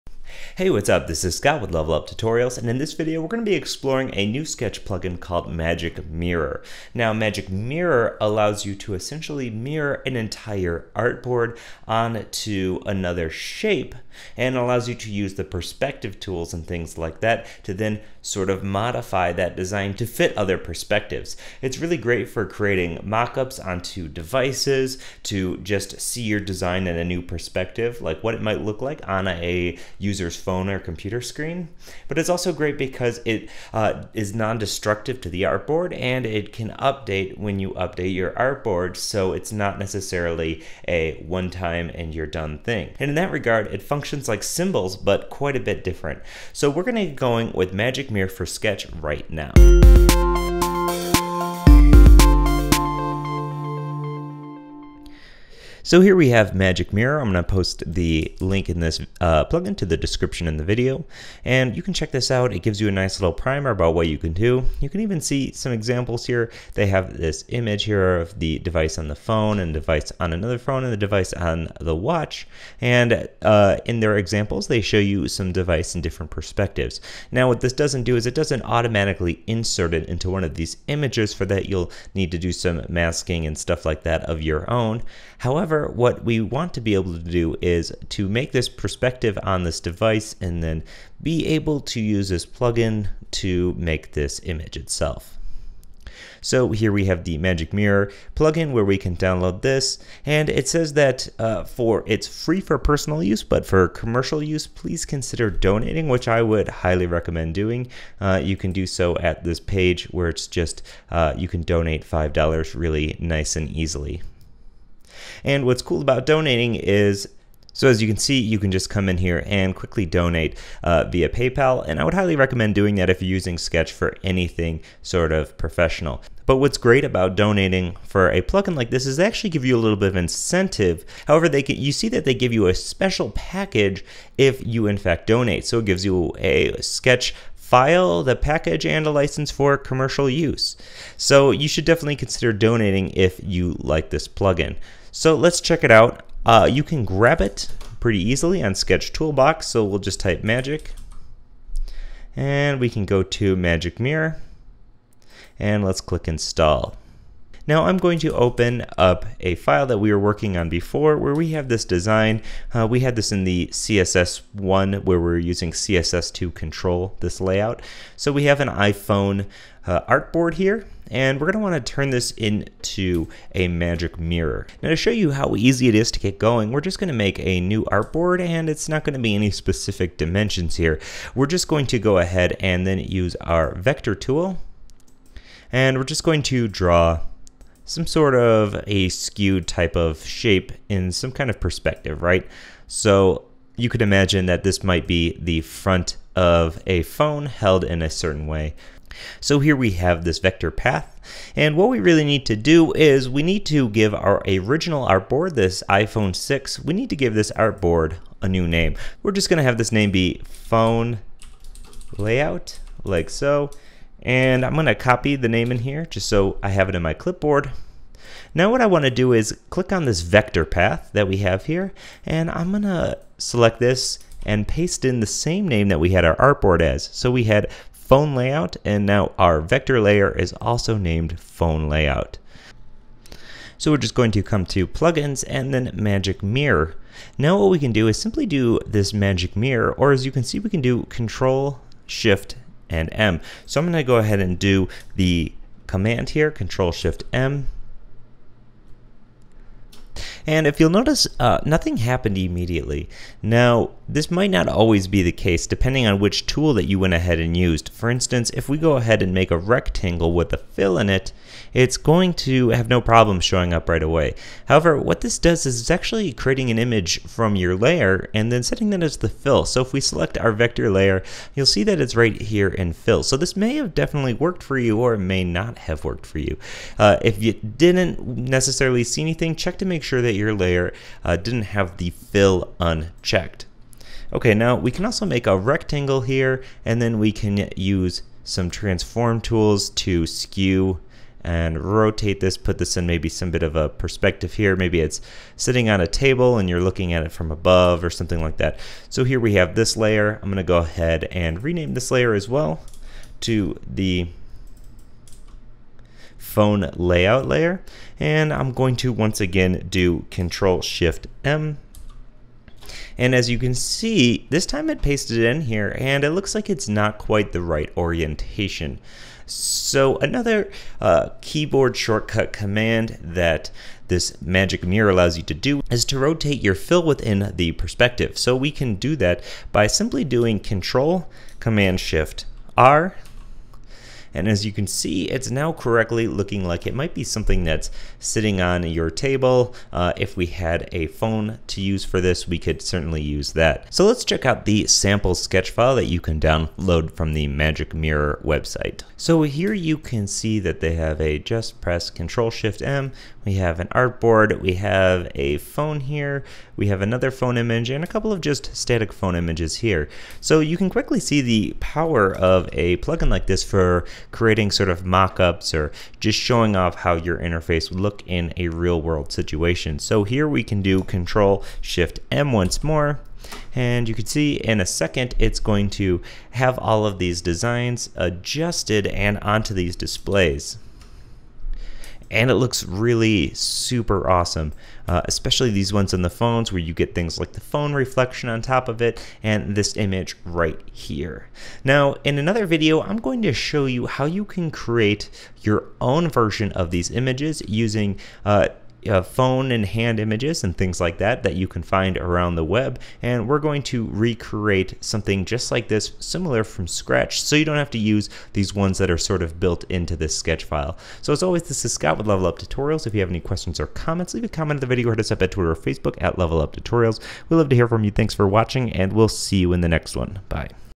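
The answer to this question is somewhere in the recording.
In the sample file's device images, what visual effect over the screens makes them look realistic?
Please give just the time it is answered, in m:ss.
6:27.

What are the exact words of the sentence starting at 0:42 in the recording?
And in that regard, it functions like symbols but quite a bit different.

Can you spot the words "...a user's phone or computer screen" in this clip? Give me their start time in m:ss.
0:29.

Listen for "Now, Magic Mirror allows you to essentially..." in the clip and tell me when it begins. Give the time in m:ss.
0:06.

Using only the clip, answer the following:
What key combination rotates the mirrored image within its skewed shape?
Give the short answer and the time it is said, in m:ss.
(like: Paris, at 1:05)
Control Command Shift R, at 5:30.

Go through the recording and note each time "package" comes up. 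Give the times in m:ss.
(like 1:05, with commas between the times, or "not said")
2:13, 2:18.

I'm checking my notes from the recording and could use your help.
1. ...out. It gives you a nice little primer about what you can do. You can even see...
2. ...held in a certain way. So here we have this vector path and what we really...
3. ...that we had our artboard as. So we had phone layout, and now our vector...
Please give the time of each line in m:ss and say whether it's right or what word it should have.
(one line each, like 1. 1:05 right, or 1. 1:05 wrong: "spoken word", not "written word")
1. 1:02 right
2. 3:17 right
3. 3:45 right.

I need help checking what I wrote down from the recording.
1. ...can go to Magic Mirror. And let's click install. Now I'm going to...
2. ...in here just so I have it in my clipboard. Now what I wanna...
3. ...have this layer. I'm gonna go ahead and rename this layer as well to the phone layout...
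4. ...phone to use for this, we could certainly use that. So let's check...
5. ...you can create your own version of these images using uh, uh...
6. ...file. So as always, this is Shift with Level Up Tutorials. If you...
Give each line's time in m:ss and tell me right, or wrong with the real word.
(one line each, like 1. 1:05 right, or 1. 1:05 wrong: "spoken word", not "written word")
1. 2:32 right
2. 3:35 right
3. 4:59 right
4. 5:41 right
5. 6:34 right
6. 6:50 wrong: "Scott", not "Shift".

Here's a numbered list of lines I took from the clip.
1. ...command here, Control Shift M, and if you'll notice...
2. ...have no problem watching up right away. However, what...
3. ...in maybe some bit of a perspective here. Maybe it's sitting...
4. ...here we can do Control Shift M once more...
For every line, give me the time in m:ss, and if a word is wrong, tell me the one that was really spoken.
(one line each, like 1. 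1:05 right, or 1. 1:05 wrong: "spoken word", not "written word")
1. 4:05 right
2. 4:22 wrong: "showing", not "watching"
3. 4:52 right
4. 6:10 right.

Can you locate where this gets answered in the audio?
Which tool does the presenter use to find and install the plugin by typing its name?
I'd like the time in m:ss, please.
2:28.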